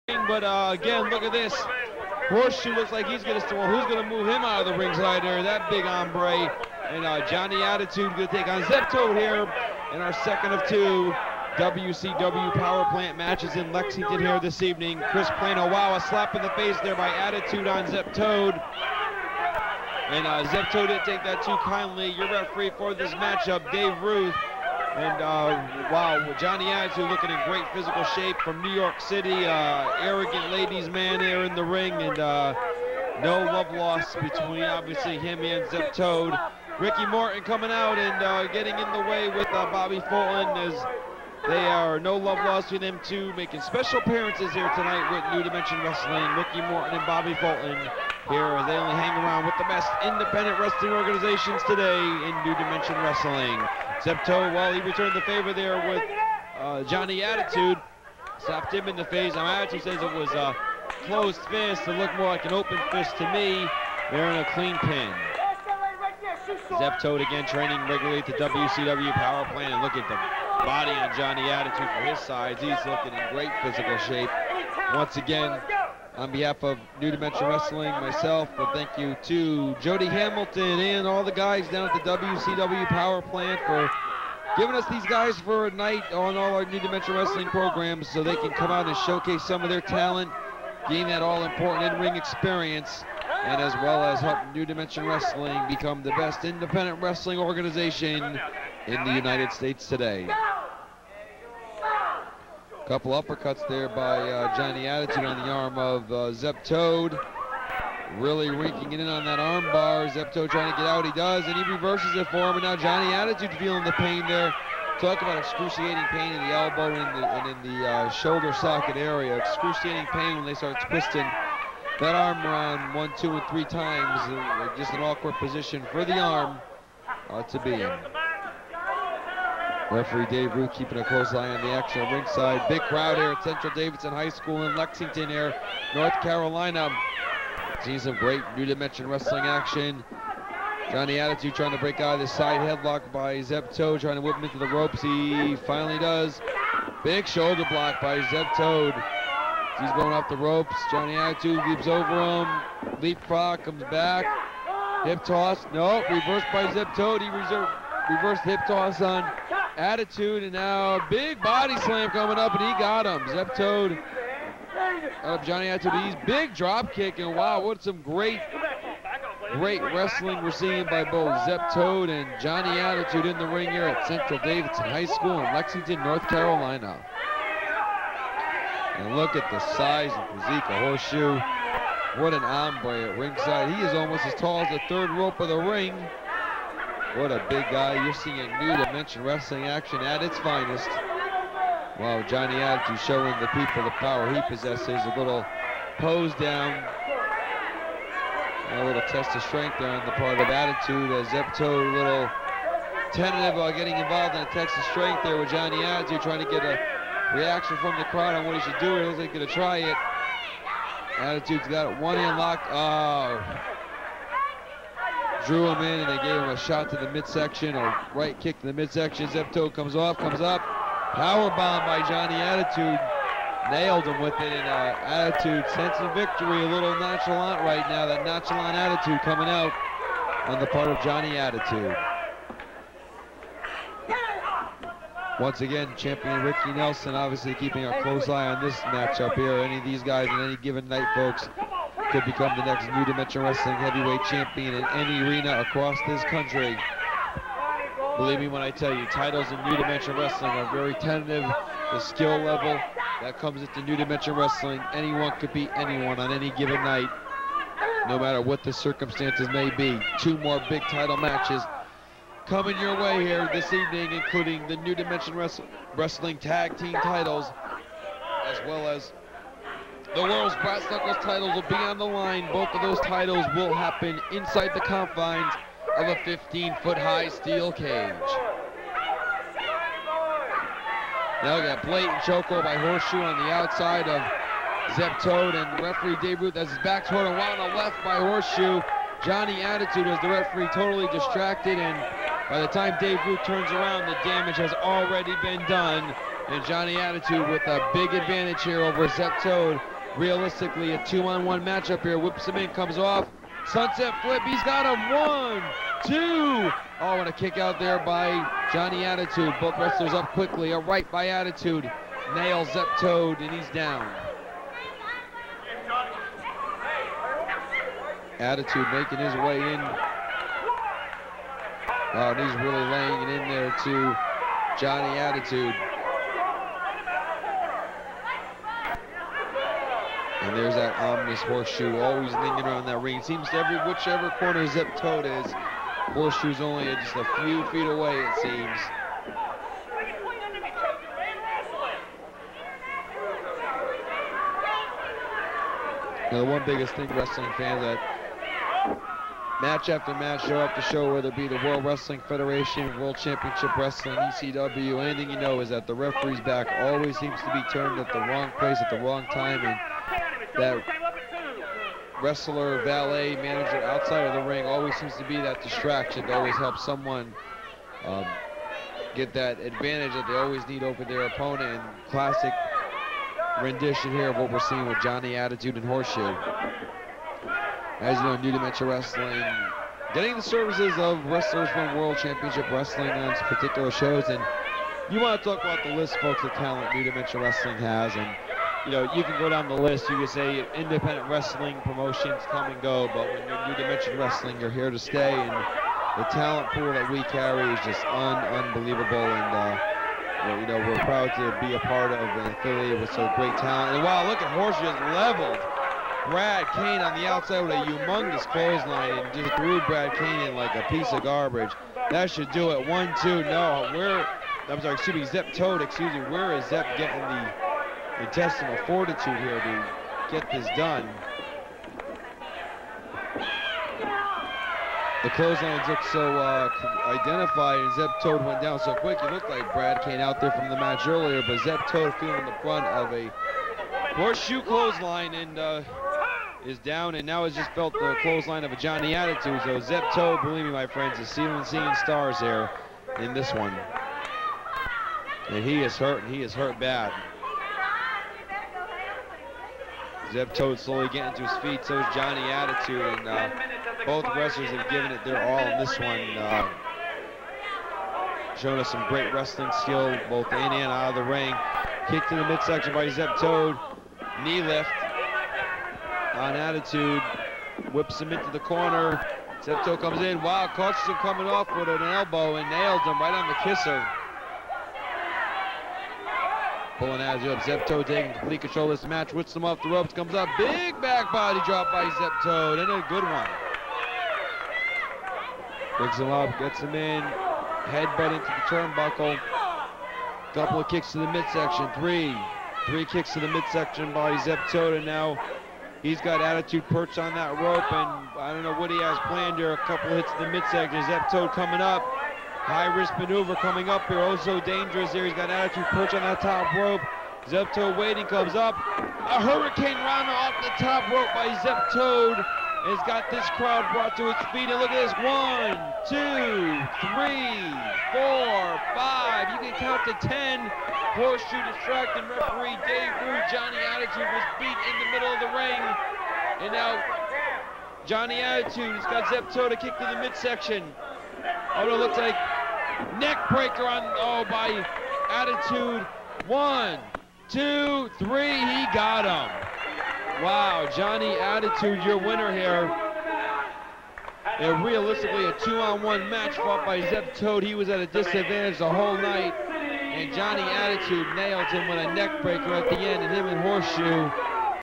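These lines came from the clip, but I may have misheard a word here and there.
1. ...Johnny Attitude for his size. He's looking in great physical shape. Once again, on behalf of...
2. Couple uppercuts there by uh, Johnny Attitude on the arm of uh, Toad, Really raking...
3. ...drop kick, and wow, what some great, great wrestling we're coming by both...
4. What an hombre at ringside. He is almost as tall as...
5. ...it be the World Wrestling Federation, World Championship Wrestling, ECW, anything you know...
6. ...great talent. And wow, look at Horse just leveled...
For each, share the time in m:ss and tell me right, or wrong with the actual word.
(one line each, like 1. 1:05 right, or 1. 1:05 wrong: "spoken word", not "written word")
1. 1:11 right
2. 1:42 right
3. 2:46 wrong: "seeing", not "coming"
4. 3:02 right
5. 5:51 right
6. 6:43 right.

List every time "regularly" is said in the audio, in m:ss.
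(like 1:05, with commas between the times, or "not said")
1:07.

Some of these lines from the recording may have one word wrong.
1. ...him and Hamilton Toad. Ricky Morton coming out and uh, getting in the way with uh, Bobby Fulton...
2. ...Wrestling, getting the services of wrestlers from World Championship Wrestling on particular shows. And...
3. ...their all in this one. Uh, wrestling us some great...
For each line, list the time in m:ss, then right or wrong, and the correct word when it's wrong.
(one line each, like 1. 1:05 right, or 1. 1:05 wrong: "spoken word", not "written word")
1. 0:35 wrong: "Zep", not "Hamilton"
2. 6:18 right
3. 7:35 wrong: "showing", not "wrestling".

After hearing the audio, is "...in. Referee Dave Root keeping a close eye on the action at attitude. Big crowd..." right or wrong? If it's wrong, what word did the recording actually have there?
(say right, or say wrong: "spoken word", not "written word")
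wrong: "ringside", not "attitude".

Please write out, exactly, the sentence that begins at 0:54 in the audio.
Zep Toad, while he returned the favor there with uh, Johnny Attitude, slapped him in the face.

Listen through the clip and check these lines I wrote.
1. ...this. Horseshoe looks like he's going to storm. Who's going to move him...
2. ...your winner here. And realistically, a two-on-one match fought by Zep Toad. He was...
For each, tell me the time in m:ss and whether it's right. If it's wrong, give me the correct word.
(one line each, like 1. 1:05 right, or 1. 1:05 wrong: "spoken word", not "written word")
1. 0:01 right
2. 9:02 right.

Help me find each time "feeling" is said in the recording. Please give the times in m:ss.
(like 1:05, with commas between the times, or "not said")
1:53, 7:12.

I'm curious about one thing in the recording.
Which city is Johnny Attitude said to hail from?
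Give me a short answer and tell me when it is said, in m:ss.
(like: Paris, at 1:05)
New York City, at 0:28.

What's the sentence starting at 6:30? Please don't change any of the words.
You can say independent wrestling promotions come and go, but when you're New Dimension Wrestling, you're here to stay.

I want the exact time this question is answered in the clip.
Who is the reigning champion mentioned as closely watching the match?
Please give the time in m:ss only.
3:56.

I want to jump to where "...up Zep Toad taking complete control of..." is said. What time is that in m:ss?
7:57.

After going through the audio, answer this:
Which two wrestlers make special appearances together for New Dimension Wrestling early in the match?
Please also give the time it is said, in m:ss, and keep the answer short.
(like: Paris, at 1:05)
Ricky Morton and Bobby Fulton, at 0:46.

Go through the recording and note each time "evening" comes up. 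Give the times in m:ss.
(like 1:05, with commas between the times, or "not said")
0:14, 4:23.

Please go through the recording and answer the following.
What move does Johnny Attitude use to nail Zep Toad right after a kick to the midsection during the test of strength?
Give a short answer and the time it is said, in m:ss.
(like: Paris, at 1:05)
Power bomb, at 3:41.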